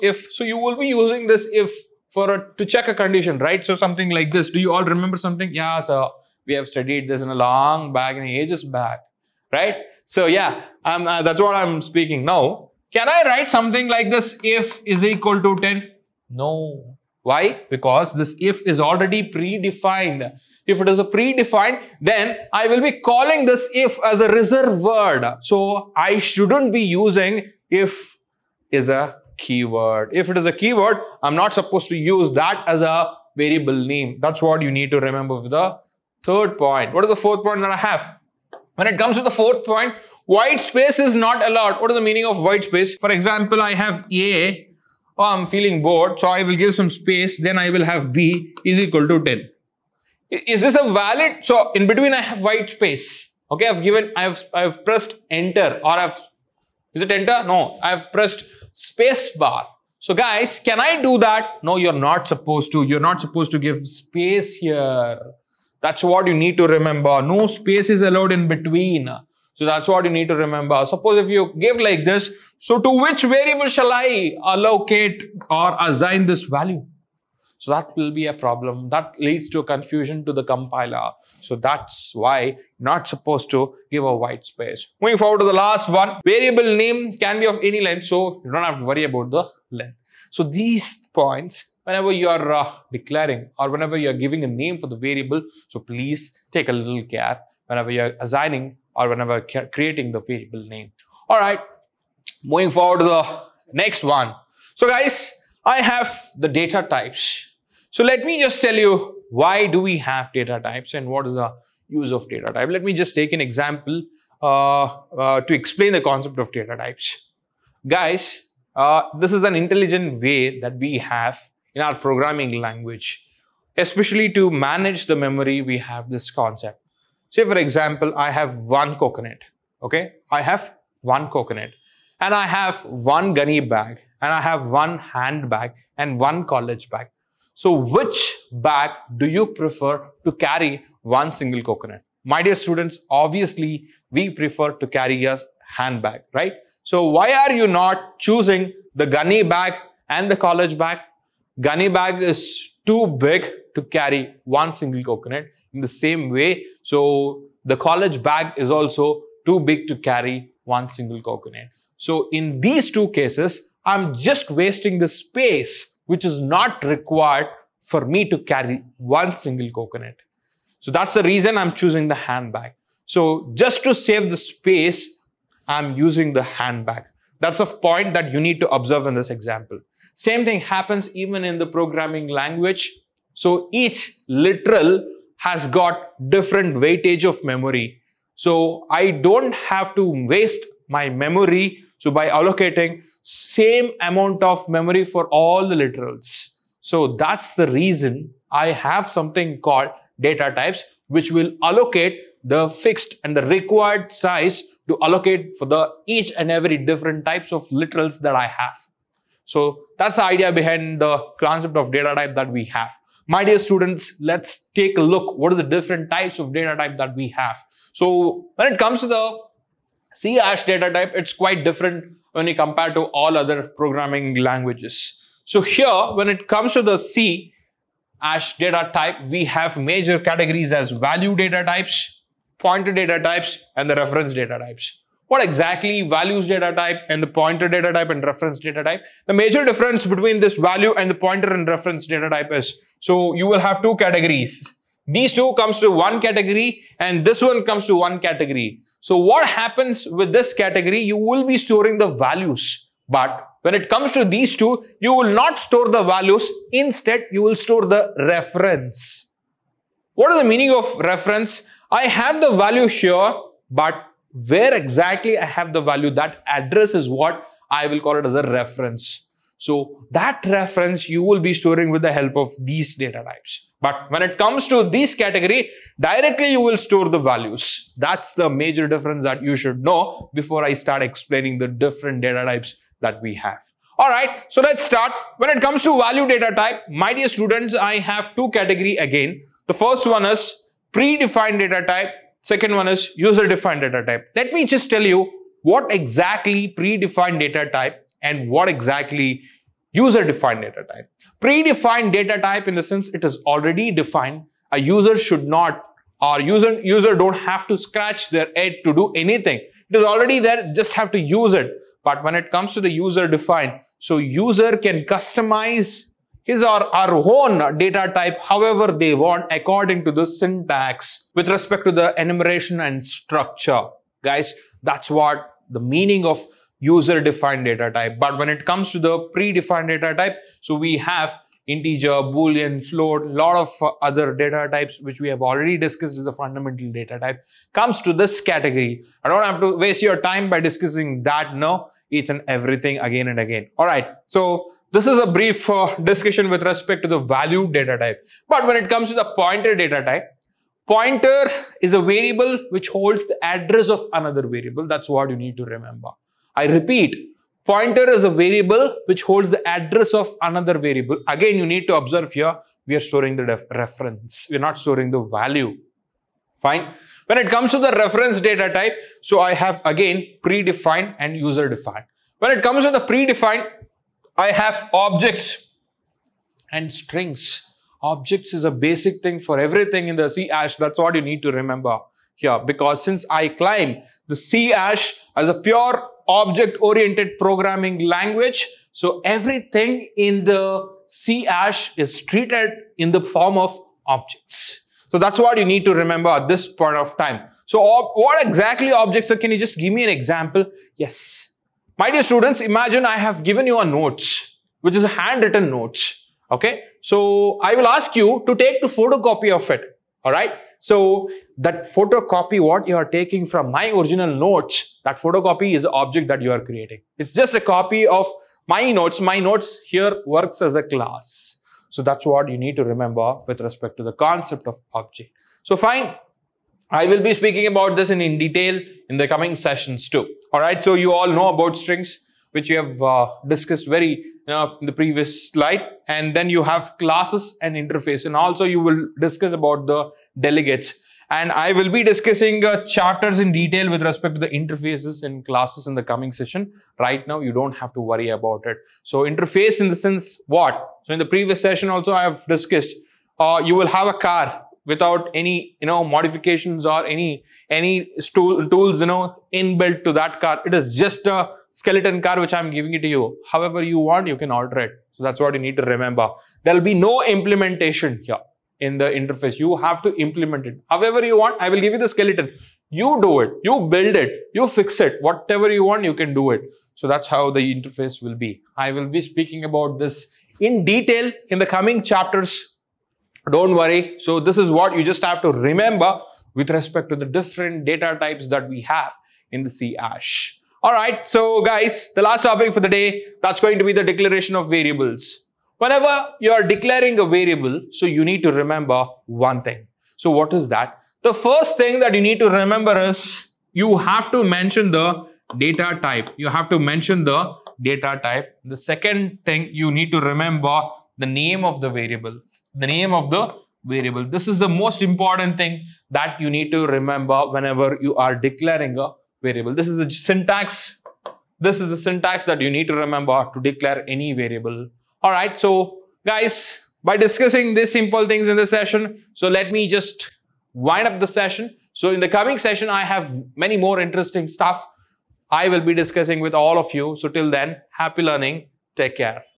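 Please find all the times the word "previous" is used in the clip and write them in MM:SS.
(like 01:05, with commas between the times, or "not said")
07:14, 07:31.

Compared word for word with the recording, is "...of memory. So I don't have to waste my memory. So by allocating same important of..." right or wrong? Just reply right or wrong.
wrong.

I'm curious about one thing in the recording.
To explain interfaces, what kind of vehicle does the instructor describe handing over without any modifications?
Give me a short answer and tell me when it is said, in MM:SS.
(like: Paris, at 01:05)
Skeleton car, at 07:41.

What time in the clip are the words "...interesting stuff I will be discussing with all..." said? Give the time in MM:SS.
08:53.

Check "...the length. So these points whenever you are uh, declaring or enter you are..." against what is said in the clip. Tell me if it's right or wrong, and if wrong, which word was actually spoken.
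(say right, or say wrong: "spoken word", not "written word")
wrong: "whenever", not "enter".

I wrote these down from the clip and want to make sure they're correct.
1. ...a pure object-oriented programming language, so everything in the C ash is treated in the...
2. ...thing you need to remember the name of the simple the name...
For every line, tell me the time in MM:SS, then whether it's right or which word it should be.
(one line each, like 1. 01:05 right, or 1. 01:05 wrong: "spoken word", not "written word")
1. 06:25 right
2. 08:29 wrong: "variable", not "simple".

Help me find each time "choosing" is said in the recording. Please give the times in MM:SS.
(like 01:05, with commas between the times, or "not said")
02:28, 02:51.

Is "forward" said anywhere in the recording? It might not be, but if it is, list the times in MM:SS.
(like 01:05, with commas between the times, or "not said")
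01:25, 01:42.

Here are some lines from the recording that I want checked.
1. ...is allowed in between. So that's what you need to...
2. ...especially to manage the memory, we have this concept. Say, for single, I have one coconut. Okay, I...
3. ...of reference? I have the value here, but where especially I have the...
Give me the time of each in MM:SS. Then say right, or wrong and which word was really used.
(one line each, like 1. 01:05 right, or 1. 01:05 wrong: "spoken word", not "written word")
1. 01:07 right
2. 02:03 wrong: "example", not "single"
3. 04:20 wrong: "exactly", not "especially".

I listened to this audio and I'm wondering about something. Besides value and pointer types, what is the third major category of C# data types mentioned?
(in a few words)
Reference data types.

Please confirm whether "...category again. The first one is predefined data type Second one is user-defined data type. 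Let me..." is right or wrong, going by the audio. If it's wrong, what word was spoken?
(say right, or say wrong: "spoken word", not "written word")
right.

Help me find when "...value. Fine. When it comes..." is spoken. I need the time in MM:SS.
06:05.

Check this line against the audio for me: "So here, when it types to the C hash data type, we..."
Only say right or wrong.
wrong.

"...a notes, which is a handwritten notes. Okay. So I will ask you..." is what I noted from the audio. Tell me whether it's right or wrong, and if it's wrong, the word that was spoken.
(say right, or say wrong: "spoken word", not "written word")
right.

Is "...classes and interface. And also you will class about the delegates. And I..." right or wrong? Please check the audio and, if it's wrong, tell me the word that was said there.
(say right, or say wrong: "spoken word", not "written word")
wrong: "discuss", not "class".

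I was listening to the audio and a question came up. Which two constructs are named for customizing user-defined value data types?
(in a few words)
Enumeration and structure.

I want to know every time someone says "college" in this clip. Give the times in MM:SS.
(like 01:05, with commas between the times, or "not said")
02:16, 02:30, 02:37.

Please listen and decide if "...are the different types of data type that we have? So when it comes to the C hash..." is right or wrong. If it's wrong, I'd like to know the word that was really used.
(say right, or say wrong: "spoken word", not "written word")
right.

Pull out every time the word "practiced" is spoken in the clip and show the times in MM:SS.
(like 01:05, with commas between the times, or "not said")
not said.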